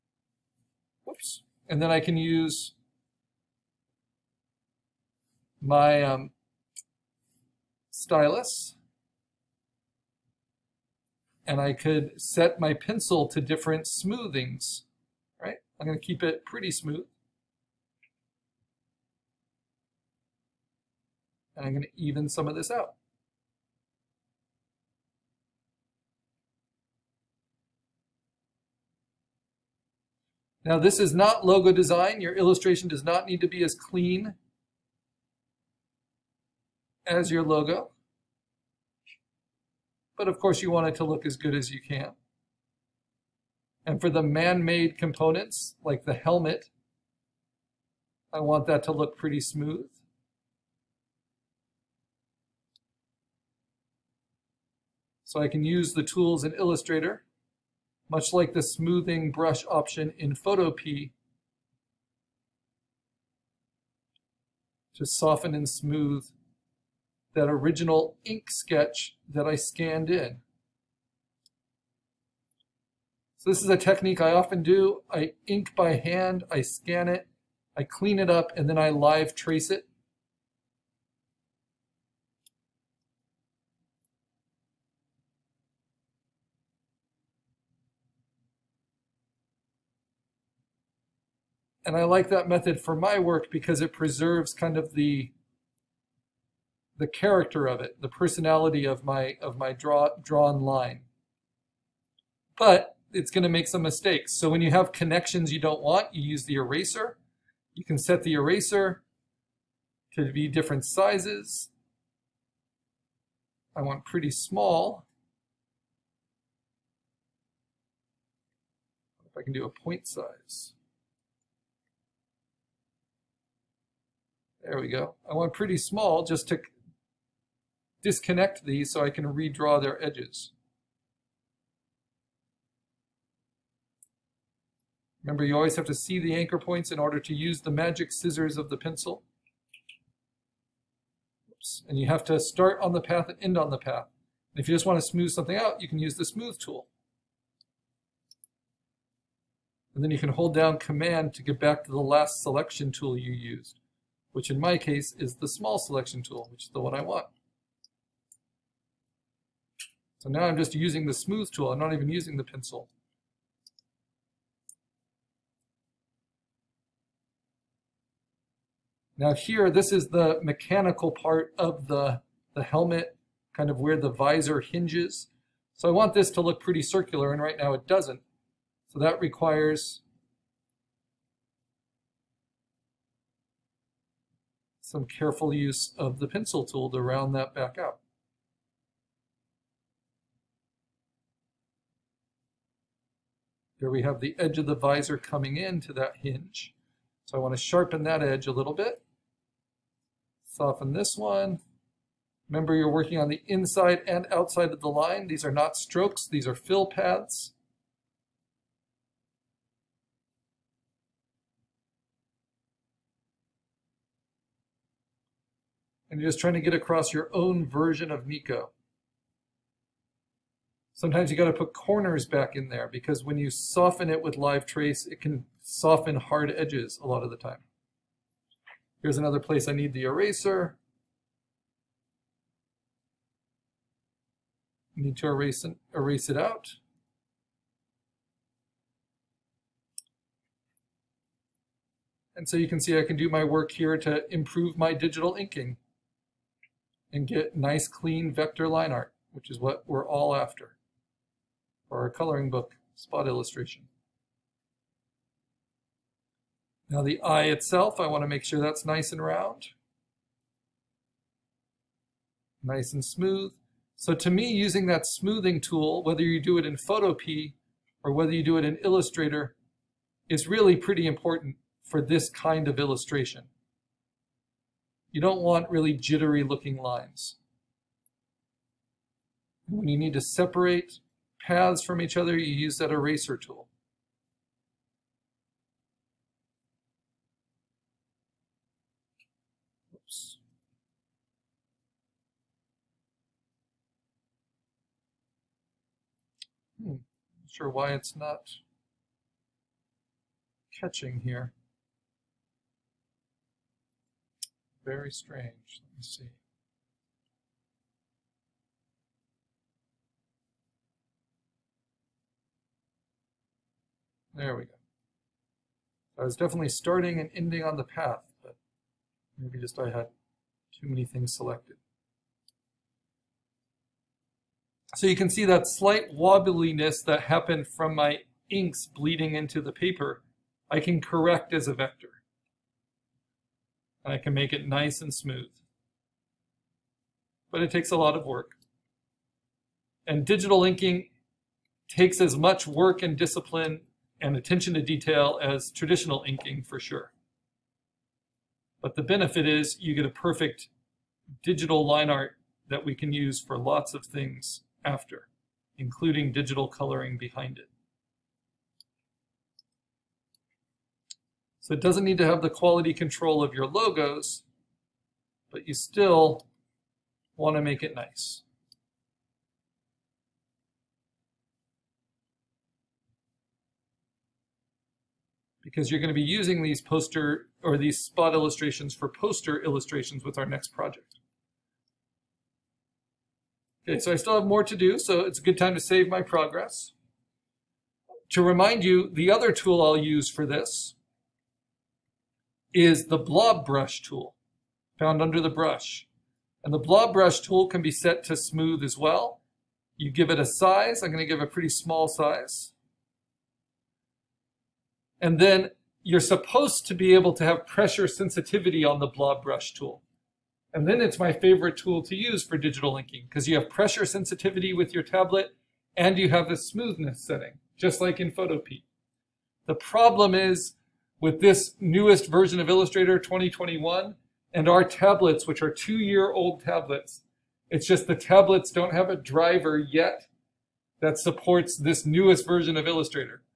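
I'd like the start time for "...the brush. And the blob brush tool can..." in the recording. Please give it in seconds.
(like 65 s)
395 s.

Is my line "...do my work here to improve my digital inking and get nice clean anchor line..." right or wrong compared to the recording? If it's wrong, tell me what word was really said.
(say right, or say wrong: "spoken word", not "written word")
wrong: "vector", not "anchor".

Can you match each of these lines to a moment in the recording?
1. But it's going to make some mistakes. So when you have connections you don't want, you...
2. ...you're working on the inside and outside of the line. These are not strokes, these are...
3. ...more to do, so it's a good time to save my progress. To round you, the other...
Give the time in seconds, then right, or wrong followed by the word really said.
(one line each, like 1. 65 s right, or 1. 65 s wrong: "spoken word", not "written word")
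1. 102 s right
2. 202 s right
3. 384 s wrong: "remind", not "round".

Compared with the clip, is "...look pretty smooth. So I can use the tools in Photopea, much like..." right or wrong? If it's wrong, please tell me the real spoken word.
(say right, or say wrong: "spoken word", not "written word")
wrong: "Illustrator", not "Photopea".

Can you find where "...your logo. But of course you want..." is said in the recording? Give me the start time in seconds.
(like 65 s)
37 s.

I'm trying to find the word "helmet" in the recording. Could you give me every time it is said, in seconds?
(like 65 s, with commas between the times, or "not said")
46 s, 172 s.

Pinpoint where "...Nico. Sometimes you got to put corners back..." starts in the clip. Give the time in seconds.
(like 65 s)
218 s.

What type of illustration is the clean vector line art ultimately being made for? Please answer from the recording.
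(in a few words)
coloring book spot illustration.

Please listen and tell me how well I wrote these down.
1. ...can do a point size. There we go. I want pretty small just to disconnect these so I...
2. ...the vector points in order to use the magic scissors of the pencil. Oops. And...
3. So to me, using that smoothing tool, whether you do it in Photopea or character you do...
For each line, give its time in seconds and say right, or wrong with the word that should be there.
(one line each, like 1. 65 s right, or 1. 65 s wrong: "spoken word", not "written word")
1. 119 s right
2. 136 s wrong: "anchor", not "vector"
3. 263 s wrong: "whether", not "character".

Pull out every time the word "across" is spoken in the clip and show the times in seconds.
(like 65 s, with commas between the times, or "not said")
216 s.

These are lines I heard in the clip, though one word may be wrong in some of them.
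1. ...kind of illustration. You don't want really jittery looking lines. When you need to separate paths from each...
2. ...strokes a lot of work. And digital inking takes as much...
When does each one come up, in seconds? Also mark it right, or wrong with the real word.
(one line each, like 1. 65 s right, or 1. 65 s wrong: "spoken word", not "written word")
1. 272 s right
2. 337 s wrong: "takes", not "strokes".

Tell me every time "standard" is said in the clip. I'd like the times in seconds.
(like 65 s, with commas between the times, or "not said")
not said.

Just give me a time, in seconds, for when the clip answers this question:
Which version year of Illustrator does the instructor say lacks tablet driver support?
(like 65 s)
423 s.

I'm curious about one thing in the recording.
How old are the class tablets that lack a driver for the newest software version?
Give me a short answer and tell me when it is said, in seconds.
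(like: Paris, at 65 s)
two year old, at 425 s.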